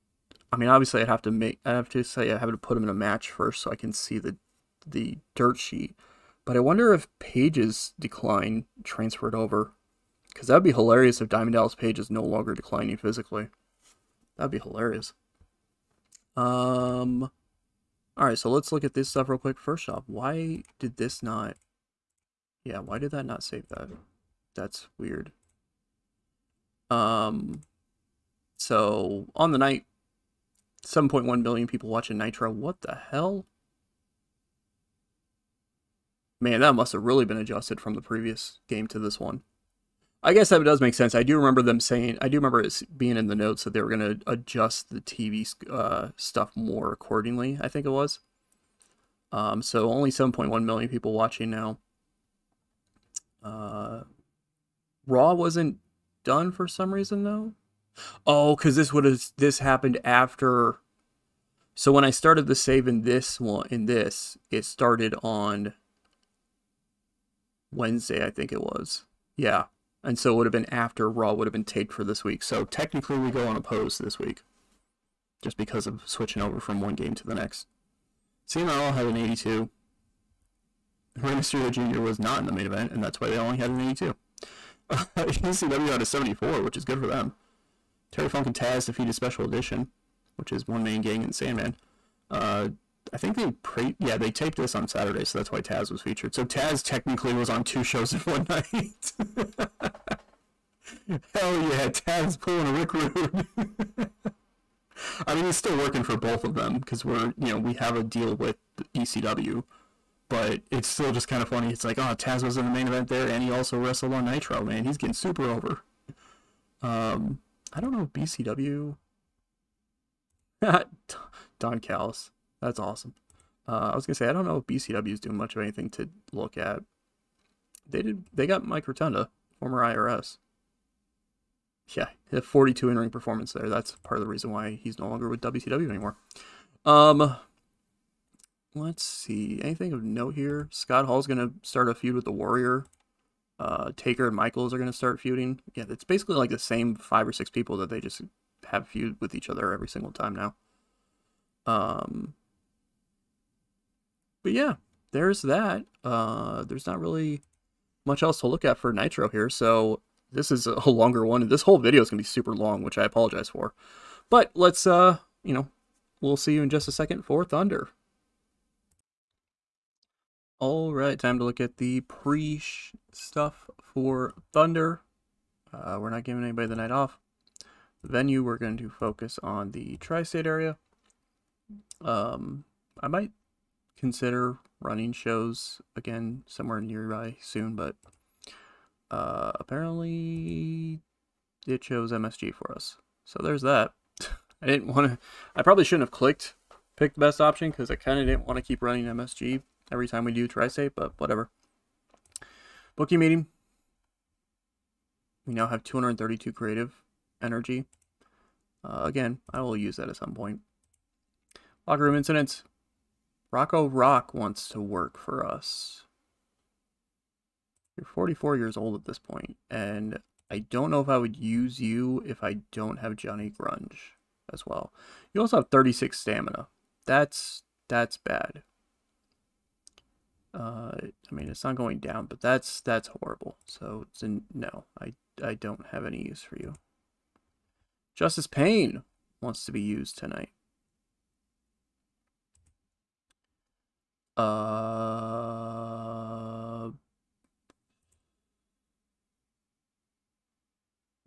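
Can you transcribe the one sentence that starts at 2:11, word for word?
Yeah, a 42 in ring performance there.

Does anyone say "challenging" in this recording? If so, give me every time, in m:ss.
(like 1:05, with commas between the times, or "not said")
not said.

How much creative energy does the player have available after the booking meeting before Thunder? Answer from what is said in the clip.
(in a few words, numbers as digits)
232.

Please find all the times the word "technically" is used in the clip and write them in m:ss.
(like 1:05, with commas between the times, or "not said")
1:12, 1:36.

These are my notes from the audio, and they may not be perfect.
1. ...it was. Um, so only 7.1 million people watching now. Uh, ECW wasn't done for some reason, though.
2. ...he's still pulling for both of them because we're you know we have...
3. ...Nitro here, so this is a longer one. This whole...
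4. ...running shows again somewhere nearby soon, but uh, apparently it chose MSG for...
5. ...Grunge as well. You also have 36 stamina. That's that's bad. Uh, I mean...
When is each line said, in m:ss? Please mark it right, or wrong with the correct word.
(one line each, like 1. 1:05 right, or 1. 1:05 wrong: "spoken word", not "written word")
1. 0:47 wrong: "Raw", not "ECW"
2. 1:45 wrong: "working", not "pulling"
3. 2:38 right
4. 3:04 right
5. 3:43 right.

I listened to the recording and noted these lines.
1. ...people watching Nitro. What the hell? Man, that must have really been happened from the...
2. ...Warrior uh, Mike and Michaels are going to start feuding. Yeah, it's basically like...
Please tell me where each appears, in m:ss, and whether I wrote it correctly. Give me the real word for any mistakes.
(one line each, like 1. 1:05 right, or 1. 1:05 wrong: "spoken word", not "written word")
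1. 0:31 wrong: "adjusted", not "happened"
2. 2:22 wrong: "Taker", not "Mike".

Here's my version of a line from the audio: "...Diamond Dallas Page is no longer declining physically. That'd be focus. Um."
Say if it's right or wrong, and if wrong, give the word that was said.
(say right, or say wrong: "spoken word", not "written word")
wrong: "hilarious", not "focus".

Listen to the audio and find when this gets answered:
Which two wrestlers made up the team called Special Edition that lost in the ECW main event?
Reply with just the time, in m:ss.
1:30.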